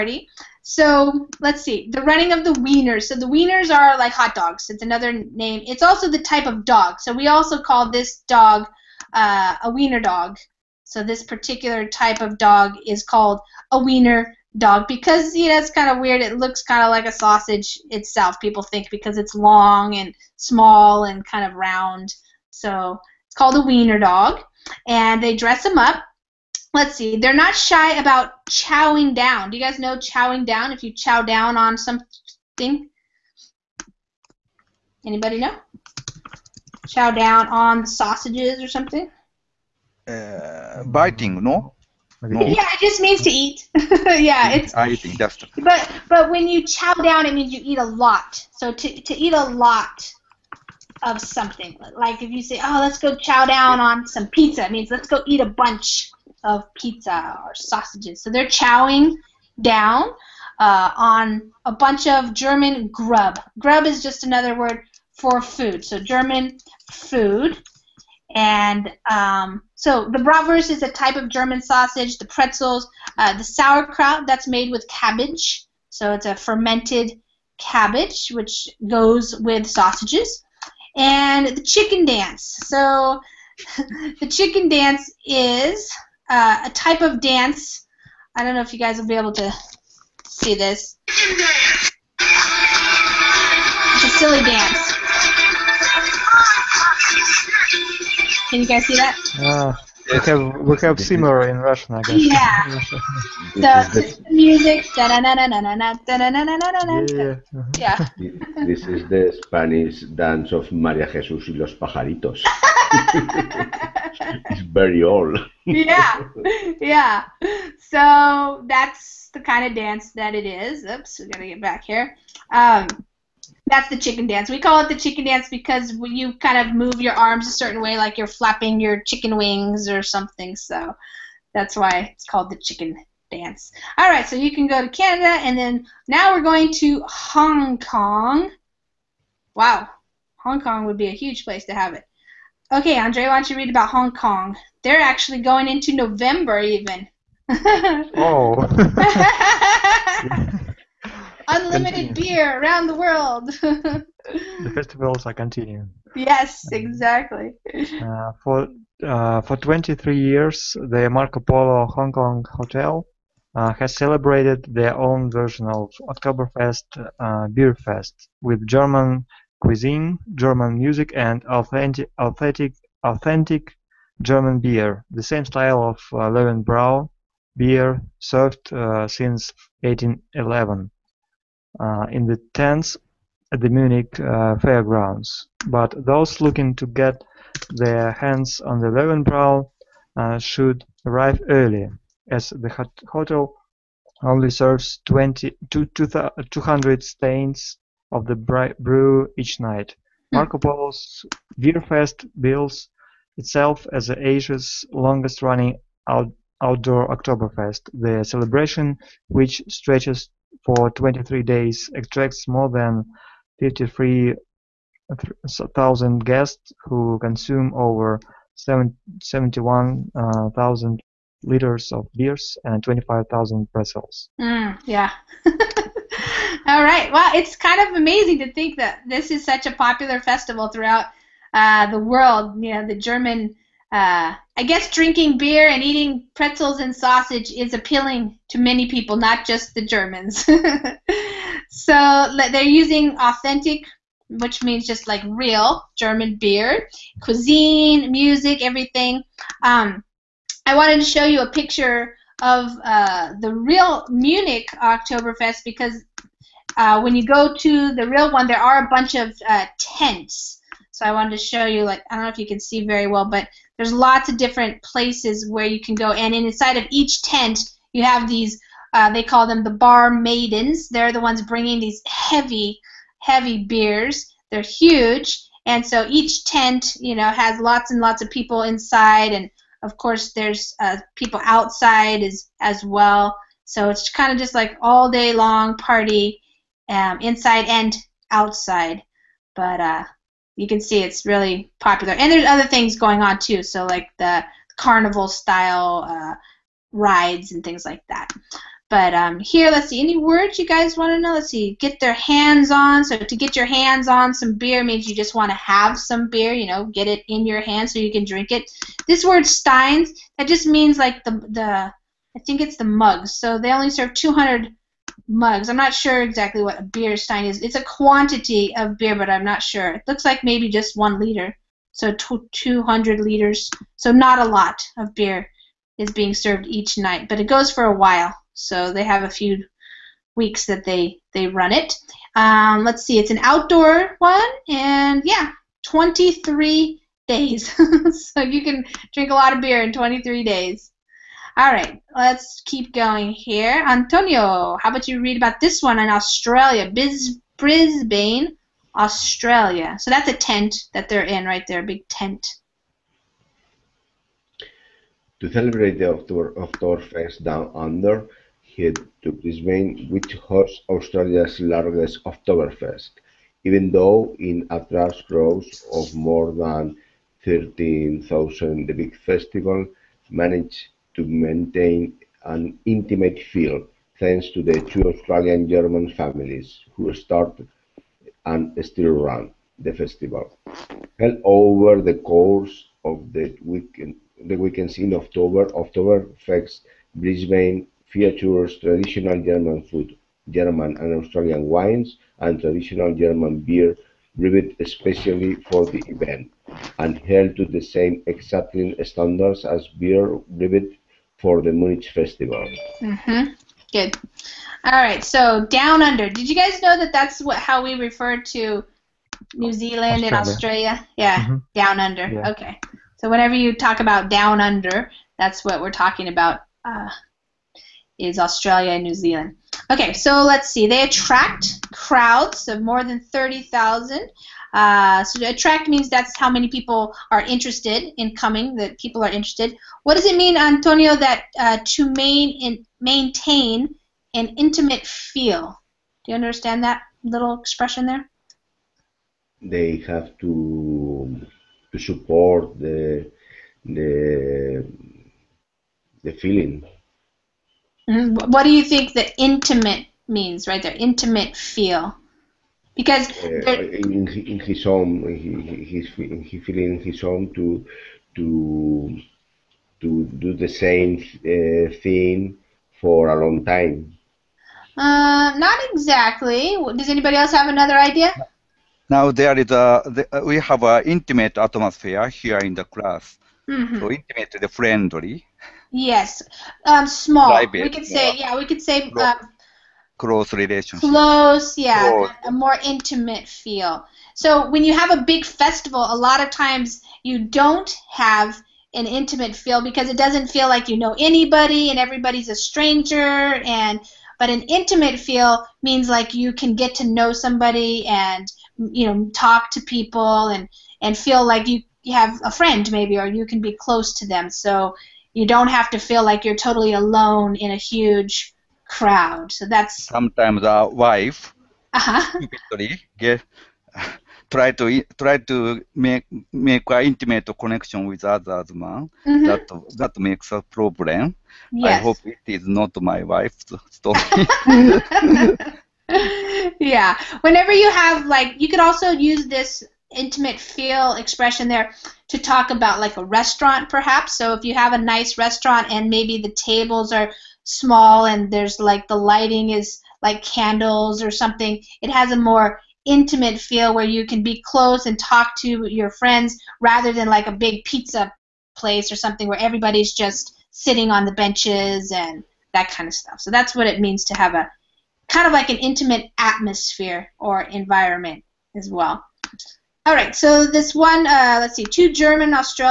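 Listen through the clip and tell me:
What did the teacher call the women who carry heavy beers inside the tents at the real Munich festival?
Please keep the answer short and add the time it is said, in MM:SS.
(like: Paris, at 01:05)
Bar maidens, at 04:29.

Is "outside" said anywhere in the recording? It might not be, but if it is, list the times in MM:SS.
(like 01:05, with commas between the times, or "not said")
04:41, 04:48.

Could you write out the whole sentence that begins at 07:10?
What does it mean, Antonio, that uh, to main in, maintain an intimate feel?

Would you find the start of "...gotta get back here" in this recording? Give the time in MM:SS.
02:01.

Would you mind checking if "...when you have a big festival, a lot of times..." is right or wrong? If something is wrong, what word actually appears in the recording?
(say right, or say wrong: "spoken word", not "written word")
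right.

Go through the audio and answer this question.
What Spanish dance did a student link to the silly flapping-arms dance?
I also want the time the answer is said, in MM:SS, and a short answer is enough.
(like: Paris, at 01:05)
Maria Jesús y los pajaritos, at 01:50.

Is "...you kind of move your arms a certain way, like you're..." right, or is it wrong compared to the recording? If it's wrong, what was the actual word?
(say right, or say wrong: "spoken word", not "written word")
right.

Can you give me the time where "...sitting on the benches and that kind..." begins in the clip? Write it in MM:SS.
09:10.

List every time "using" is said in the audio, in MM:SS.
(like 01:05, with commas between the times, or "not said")
04:02.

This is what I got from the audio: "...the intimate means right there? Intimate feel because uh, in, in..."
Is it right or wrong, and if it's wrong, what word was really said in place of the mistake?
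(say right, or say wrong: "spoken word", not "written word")
right.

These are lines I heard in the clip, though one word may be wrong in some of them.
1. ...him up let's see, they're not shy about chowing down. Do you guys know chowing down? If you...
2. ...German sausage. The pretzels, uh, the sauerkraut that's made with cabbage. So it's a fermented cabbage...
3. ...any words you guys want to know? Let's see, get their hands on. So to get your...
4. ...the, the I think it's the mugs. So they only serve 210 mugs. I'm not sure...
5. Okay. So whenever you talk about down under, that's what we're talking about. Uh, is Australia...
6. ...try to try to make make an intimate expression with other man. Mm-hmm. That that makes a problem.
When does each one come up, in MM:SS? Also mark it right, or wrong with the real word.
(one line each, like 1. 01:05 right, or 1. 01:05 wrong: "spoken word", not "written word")
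1. 00:25 right
2. 01:11 right
3. 04:59 right
4. 05:11 wrong: "200", not "210"
5. 06:52 right
6. 08:34 wrong: "connection", not "expression".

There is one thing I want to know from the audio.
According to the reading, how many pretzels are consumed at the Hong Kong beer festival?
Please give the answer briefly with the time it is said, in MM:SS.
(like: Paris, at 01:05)
25,000, at 03:42.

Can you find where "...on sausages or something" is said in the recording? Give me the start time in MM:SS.
00:37.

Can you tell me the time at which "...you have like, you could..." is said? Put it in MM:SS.
08:47.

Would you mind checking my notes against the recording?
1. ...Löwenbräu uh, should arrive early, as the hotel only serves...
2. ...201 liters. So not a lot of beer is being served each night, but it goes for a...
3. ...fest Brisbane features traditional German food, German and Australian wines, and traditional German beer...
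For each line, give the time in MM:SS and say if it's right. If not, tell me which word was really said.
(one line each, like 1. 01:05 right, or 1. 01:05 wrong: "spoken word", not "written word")
1. 03:08 right
2. 05:22 wrong: "200", not "201"
3. 06:26 right.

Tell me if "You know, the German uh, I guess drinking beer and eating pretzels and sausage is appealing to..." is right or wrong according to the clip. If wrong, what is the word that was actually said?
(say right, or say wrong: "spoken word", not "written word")
right.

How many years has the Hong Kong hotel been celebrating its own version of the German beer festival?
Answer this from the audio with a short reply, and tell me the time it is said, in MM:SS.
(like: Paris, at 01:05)
23 years, at 02:39.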